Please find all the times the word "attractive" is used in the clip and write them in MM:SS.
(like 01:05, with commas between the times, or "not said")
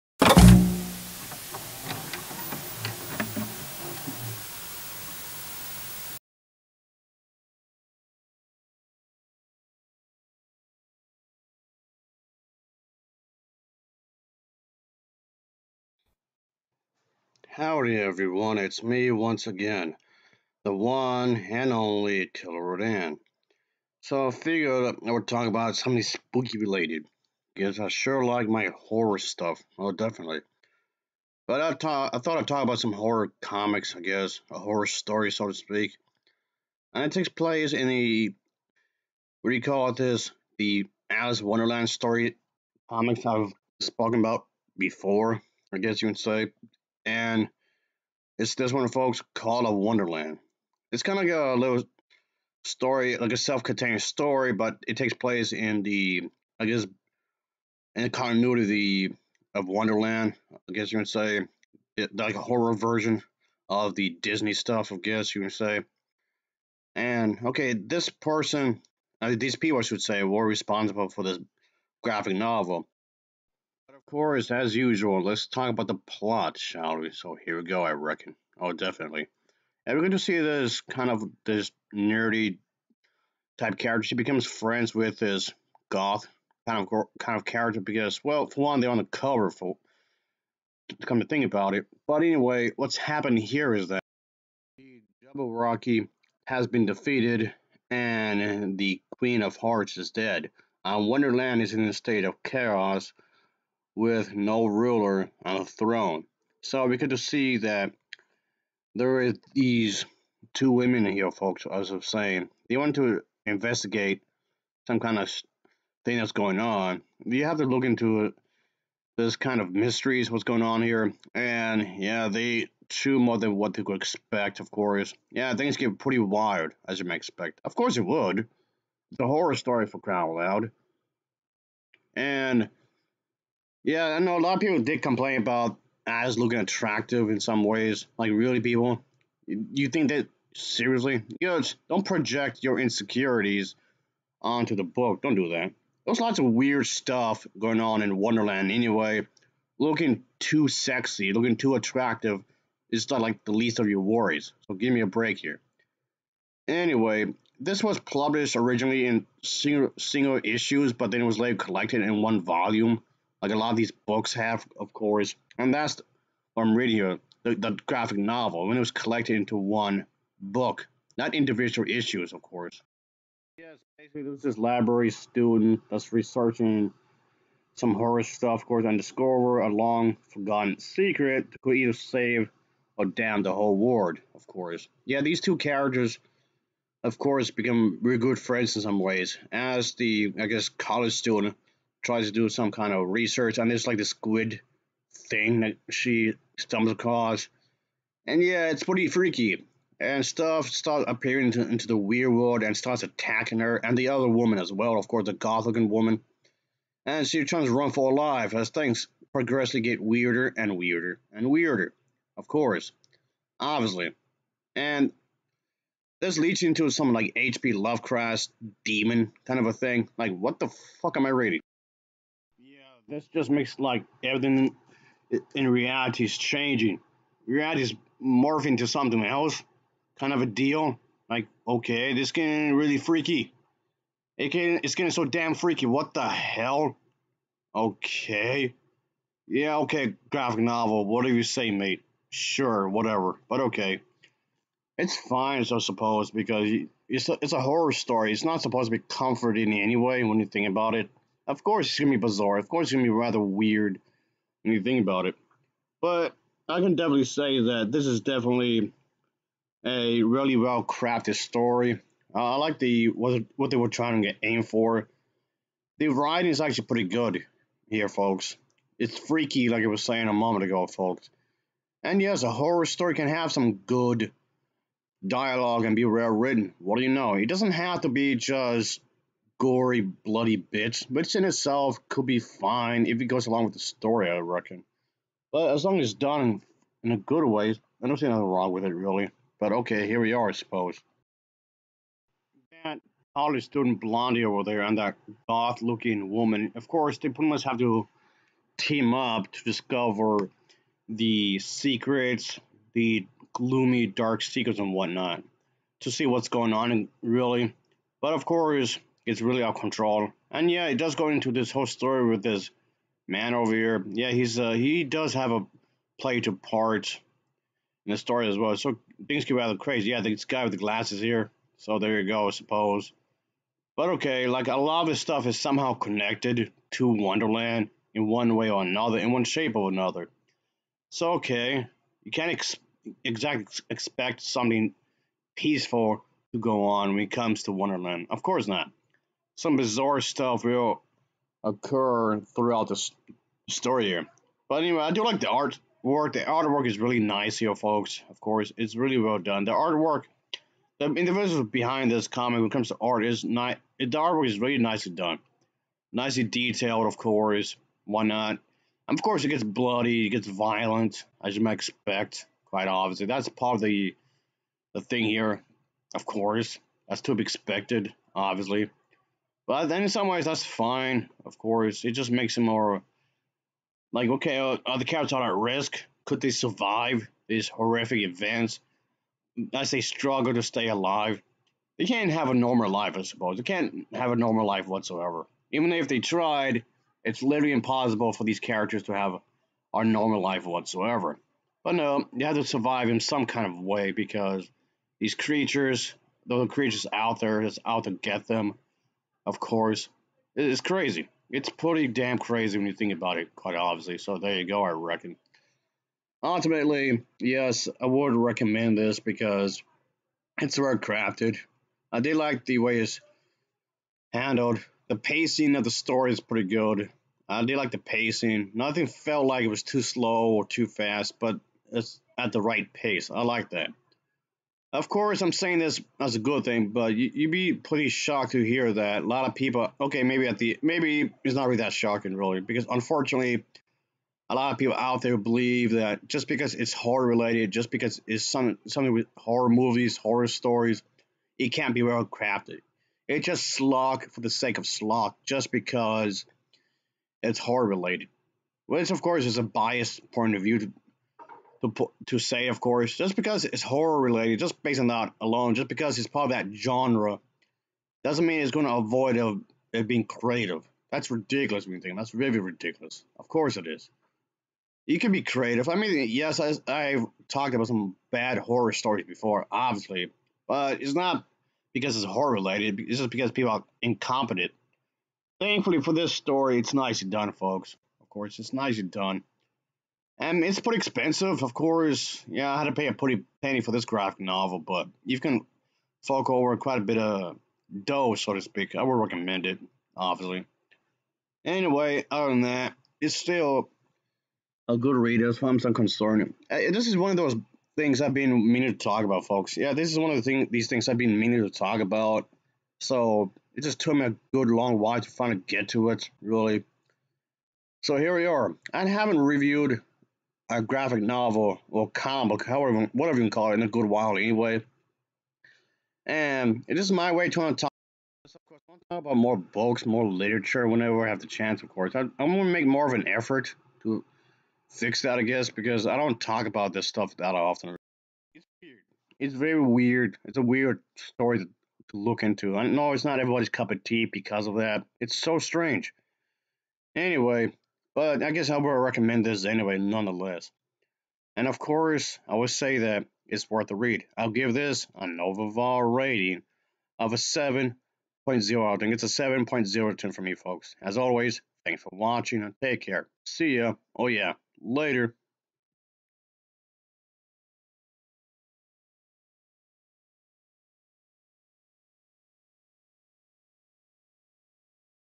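02:16, 02:31.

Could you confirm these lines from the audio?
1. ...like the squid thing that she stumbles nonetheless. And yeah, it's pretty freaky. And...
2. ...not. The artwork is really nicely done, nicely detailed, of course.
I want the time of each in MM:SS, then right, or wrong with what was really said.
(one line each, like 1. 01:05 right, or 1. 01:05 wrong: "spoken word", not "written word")
1. 03:13 wrong: "across", not "nonetheless"
2. 05:53 right.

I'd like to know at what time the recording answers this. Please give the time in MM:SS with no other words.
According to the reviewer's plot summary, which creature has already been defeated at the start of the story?
01:35.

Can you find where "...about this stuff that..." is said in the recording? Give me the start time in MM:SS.
08:46.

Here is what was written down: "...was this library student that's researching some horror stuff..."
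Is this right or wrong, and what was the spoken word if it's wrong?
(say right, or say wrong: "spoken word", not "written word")
right.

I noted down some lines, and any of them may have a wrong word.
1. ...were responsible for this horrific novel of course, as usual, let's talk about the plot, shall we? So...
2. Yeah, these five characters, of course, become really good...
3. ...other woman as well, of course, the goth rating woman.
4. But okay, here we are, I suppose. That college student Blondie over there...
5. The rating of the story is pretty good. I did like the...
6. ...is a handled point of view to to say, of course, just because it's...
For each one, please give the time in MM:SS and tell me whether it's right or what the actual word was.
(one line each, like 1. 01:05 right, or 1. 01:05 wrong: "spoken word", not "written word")
1. 01:10 wrong: "graphic", not "horrific"
2. 03:05 wrong: "two", not "five"
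3. 03:24 wrong: "looking", not "rating"
4. 04:49 right
5. 06:55 wrong: "pacing", not "rating"
6. 07:29 wrong: "biased", not "handled".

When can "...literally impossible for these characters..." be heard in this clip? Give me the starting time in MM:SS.
06:27.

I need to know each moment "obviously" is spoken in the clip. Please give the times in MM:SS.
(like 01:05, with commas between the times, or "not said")
03:33, 06:02, 06:08, 06:43, 07:49, 08:10.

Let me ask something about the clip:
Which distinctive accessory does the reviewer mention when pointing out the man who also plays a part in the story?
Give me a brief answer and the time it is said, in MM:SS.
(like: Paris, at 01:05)
glasses, at 05:20.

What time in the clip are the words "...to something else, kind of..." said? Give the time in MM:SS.
03:48.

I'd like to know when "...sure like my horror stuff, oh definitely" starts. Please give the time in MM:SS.
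00:27.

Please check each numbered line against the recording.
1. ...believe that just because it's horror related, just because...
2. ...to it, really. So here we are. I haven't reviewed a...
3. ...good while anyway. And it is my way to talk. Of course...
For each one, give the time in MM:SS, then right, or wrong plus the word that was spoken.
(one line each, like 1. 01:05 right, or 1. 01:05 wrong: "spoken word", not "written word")
1. 07:15 right
2. 08:25 right
3. 08:33 right.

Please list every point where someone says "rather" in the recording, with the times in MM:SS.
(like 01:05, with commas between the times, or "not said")
04:13, 05:19.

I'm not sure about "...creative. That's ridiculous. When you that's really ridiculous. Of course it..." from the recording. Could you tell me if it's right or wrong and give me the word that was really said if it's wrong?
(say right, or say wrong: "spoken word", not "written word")
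right.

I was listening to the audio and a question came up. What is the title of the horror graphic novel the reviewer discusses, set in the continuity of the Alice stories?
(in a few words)
Call of Wonderland.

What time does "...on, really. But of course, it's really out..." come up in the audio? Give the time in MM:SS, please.
05:06.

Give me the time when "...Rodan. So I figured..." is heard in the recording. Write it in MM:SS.
00:22.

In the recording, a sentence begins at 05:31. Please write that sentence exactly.
So okay, you can't ex- exactly expect something peaceful to go on when it comes to Wonderland.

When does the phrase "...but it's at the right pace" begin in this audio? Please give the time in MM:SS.
07:01.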